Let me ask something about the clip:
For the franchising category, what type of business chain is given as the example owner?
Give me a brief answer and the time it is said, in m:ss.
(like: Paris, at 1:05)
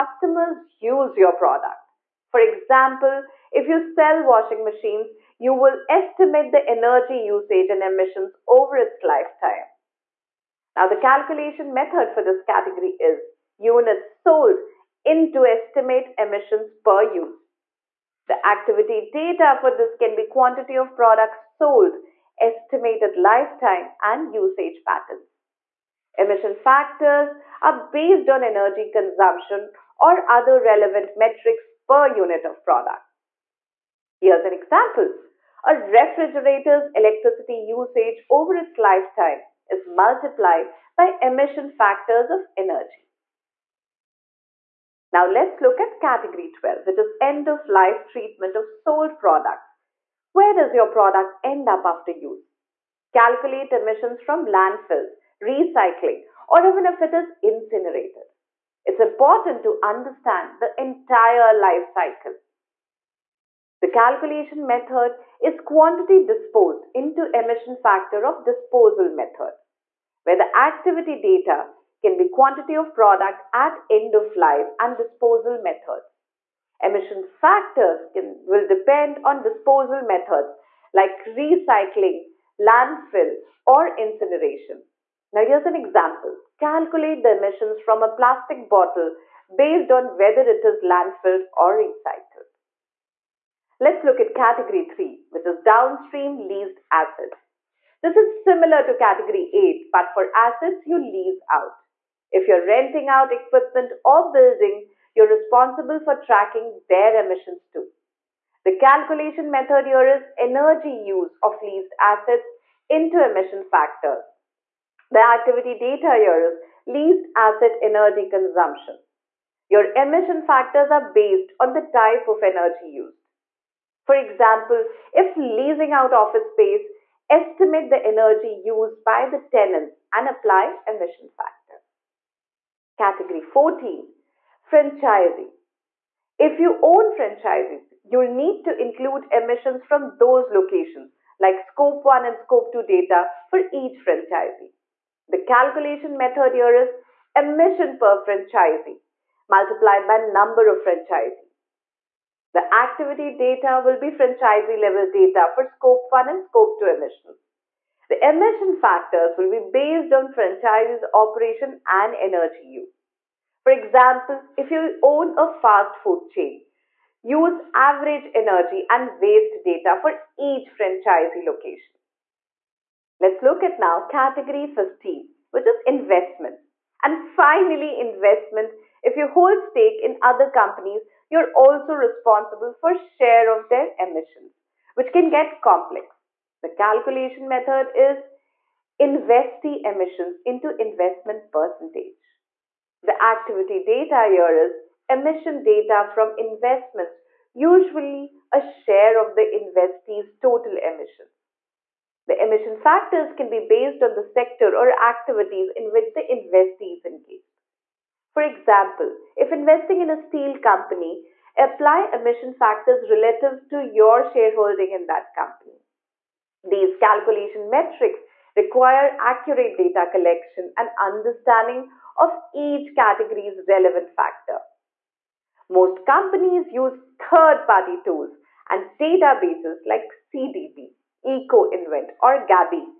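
Fast food chain, at 2:45.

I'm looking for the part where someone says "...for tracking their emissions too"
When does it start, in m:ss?
1:46.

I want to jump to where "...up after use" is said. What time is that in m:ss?
0:51.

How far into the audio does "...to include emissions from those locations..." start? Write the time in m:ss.
2:18.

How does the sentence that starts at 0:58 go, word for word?
It's important to understand the entire life cycle.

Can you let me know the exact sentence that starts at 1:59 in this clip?
Your emission factors are based on the type of energy used.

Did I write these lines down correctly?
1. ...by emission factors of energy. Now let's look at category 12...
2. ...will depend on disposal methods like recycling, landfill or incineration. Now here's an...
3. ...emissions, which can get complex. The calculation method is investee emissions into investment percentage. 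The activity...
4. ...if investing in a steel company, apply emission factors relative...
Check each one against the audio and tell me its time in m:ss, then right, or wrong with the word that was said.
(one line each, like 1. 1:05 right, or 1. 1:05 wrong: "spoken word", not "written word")
1. 0:40 right
2. 1:18 right
3. 3:03 right
4. 3:29 right.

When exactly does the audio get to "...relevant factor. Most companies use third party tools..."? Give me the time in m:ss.
3:43.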